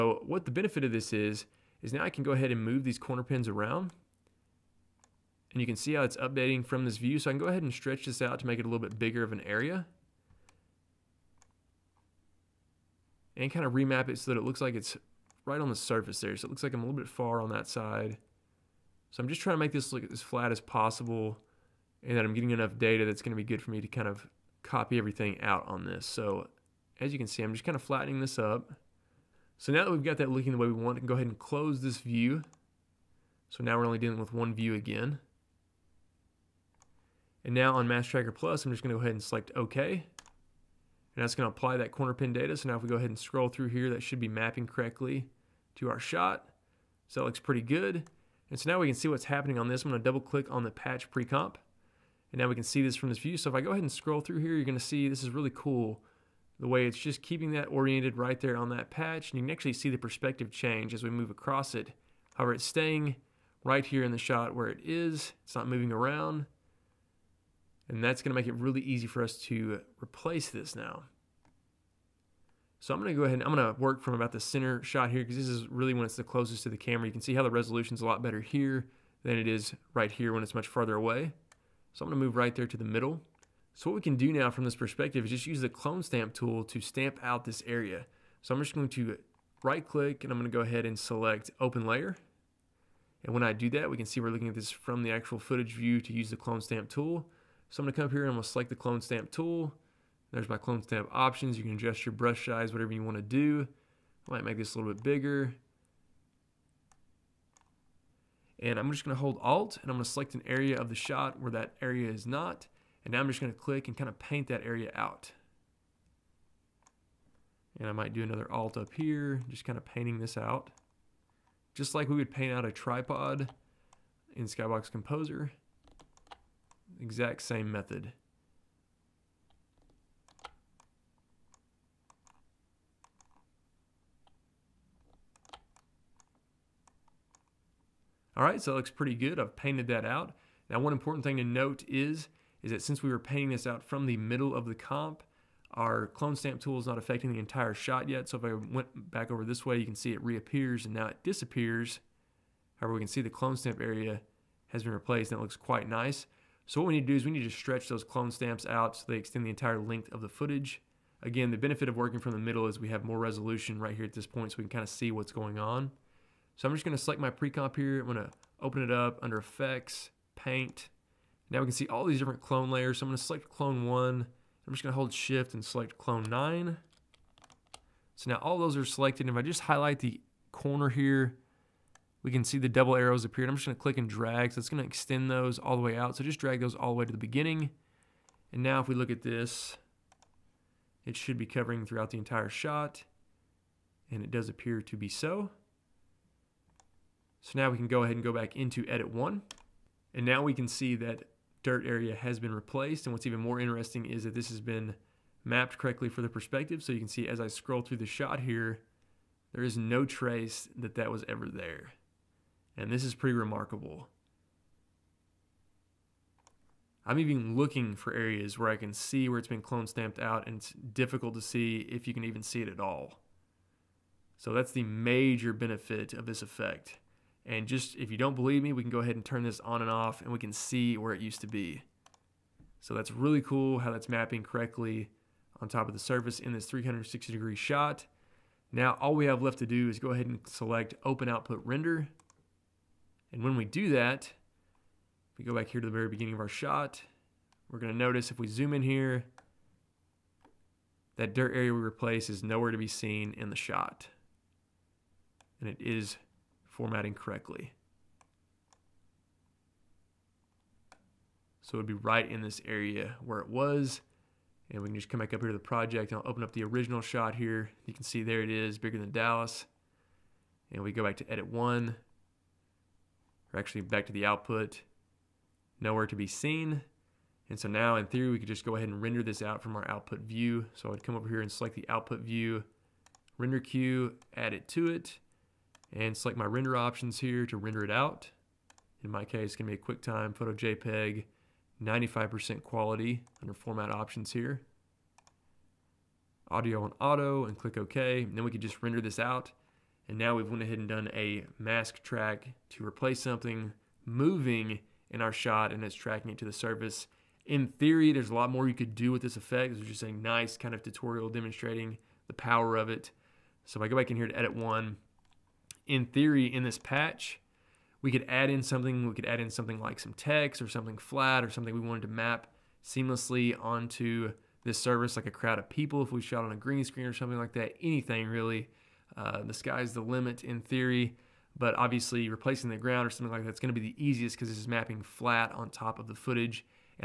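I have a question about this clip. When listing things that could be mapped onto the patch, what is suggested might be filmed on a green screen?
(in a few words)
A crowd of people.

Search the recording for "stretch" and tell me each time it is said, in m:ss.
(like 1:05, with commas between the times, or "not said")
0:07, 2:37.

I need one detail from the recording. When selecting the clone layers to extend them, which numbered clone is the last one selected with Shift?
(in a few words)
Clone 9.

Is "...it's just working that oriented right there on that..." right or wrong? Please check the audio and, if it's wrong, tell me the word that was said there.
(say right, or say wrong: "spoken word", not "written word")
wrong: "keeping", not "working".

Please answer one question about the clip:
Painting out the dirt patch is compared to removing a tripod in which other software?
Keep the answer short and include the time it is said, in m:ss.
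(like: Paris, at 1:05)
Skybox Composer, at 2:04.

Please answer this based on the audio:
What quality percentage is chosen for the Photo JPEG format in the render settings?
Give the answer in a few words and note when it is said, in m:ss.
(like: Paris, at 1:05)
95%, at 4:51.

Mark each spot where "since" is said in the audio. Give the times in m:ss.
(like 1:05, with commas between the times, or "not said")
2:22.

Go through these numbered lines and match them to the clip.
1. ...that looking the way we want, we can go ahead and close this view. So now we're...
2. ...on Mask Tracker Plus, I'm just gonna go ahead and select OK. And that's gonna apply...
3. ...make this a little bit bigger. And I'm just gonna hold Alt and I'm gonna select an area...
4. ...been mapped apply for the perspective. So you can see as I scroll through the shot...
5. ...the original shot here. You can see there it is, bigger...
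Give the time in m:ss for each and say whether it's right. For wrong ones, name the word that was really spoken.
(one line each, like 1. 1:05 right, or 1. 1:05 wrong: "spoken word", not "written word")
1. 0:30 right
2. 0:37 right
3. 1:44 right
4. 3:24 wrong: "correctly", not "apply"
5. 4:26 right.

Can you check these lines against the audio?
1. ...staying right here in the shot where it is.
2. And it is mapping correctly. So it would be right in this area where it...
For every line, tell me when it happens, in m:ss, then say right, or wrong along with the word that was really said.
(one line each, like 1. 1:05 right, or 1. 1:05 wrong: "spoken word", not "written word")
1. 1:02 right
2. 4:15 wrong: "formatting", not "mapping".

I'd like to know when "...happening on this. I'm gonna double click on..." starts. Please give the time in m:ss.
0:49.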